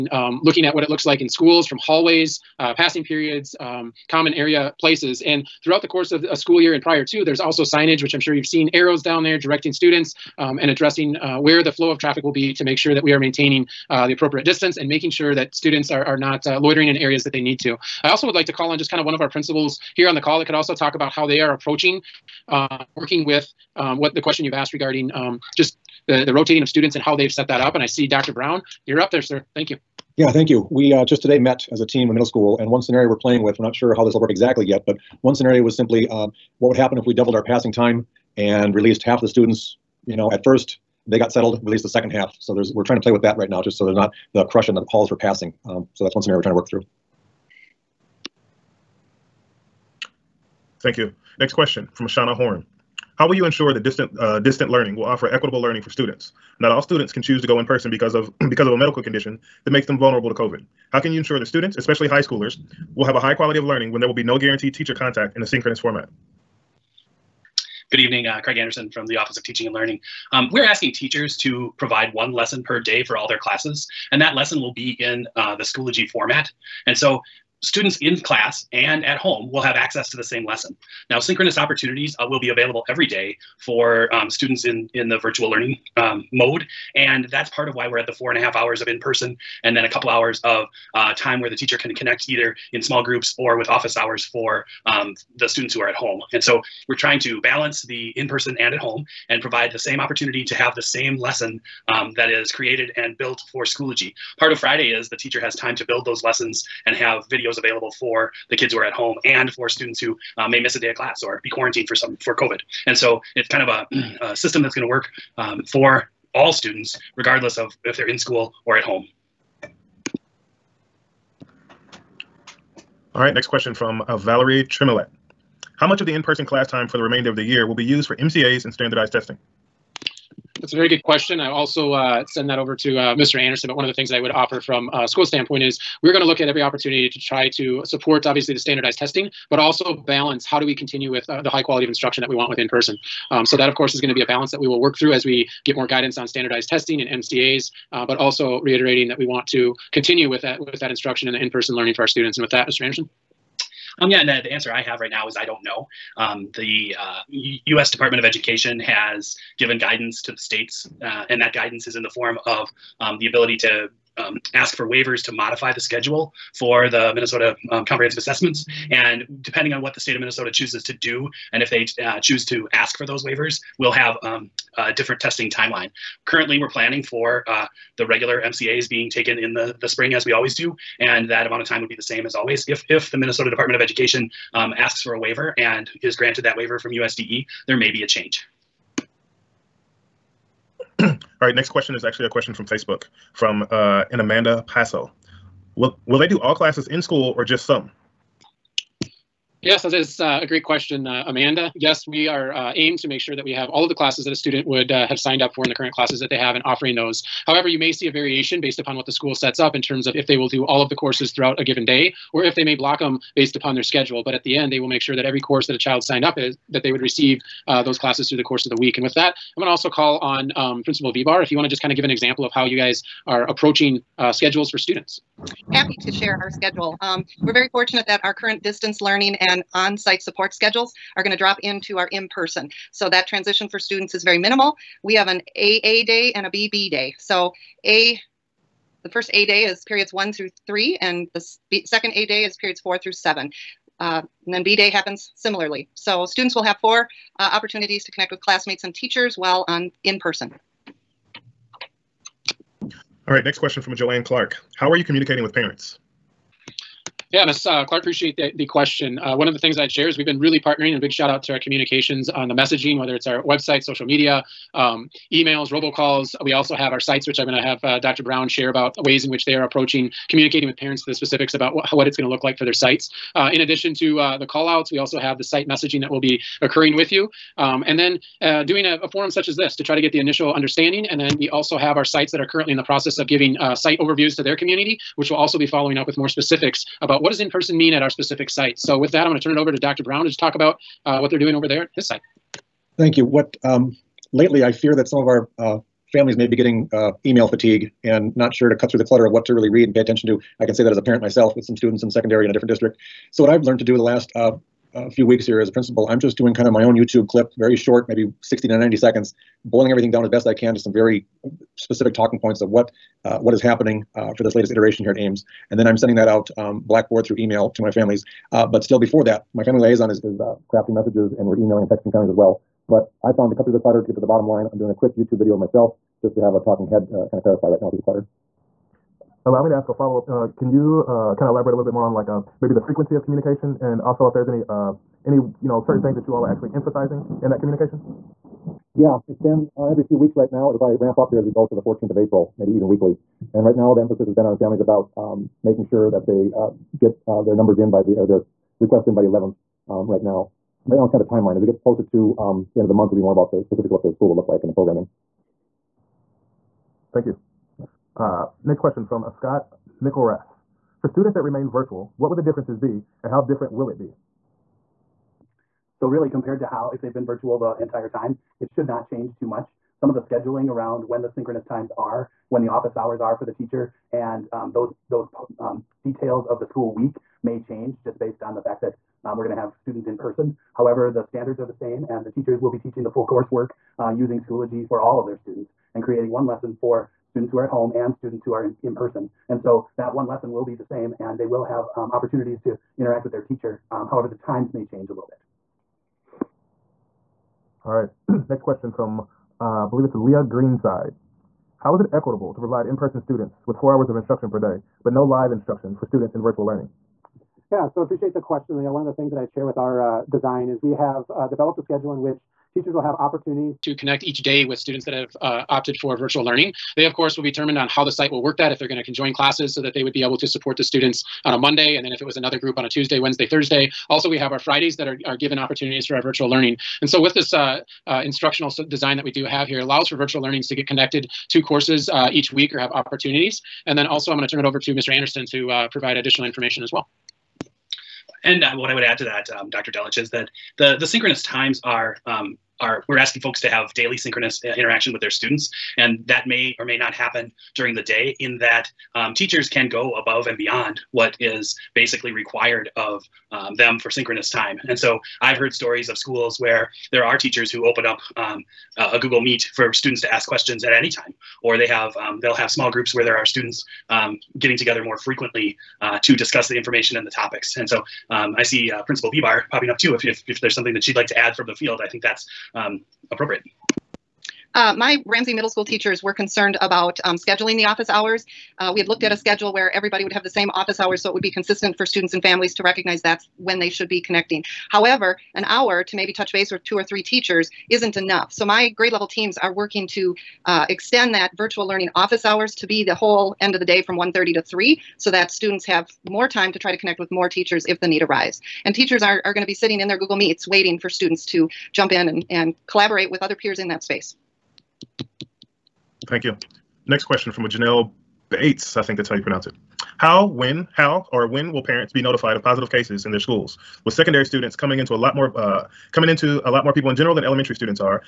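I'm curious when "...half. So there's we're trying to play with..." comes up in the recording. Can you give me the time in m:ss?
0:42.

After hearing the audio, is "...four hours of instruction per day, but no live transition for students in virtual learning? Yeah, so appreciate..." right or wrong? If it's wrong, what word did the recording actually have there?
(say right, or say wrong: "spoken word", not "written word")
wrong: "instruction", not "transition".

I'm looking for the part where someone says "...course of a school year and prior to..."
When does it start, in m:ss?
0:05.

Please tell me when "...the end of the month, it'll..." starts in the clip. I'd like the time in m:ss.
5:52.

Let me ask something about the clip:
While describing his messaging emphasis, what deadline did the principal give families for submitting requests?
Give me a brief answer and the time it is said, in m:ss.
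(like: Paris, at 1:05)
the 11th, at 5:49.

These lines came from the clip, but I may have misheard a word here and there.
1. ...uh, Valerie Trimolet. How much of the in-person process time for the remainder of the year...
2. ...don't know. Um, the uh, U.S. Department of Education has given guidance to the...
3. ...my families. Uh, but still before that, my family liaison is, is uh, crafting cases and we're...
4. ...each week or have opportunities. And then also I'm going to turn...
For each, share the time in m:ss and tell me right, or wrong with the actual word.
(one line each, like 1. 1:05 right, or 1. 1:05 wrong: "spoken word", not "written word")
1. 2:04 wrong: "class", not "process"
2. 2:35 right
3. 5:17 wrong: "messages", not "cases"
4. 7:12 right.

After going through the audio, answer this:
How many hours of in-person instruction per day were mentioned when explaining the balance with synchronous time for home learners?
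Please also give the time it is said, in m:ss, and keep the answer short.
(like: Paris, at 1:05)
4.5, at 1:28.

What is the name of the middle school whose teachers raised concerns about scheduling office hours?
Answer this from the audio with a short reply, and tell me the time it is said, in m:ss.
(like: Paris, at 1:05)
Ramsey Middle School, at 7:55.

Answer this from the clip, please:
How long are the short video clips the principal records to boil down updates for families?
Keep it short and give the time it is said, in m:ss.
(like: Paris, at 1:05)
60 to 90 seconds, at 5:08.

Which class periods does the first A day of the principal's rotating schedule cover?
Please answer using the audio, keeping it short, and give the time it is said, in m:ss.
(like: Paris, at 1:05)
periods 1 through 3, at 3:59.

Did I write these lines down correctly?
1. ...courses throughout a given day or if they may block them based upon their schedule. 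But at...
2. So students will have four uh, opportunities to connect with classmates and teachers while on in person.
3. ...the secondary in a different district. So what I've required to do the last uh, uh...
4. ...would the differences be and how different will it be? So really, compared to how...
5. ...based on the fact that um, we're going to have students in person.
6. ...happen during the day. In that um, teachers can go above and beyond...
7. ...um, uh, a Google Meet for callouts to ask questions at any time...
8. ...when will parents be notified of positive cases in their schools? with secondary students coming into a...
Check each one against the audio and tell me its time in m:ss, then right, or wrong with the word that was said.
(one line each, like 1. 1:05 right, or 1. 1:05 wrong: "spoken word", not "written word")
1. 3:30 right
2. 4:05 right
3. 5:02 wrong: "learned", not "required"
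4. 6:02 right
5. 6:18 right
6. 7:27 right
7. 7:38 wrong: "students", not "callouts"
8. 8:31 right.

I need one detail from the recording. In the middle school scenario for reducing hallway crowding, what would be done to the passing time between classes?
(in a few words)
doubled.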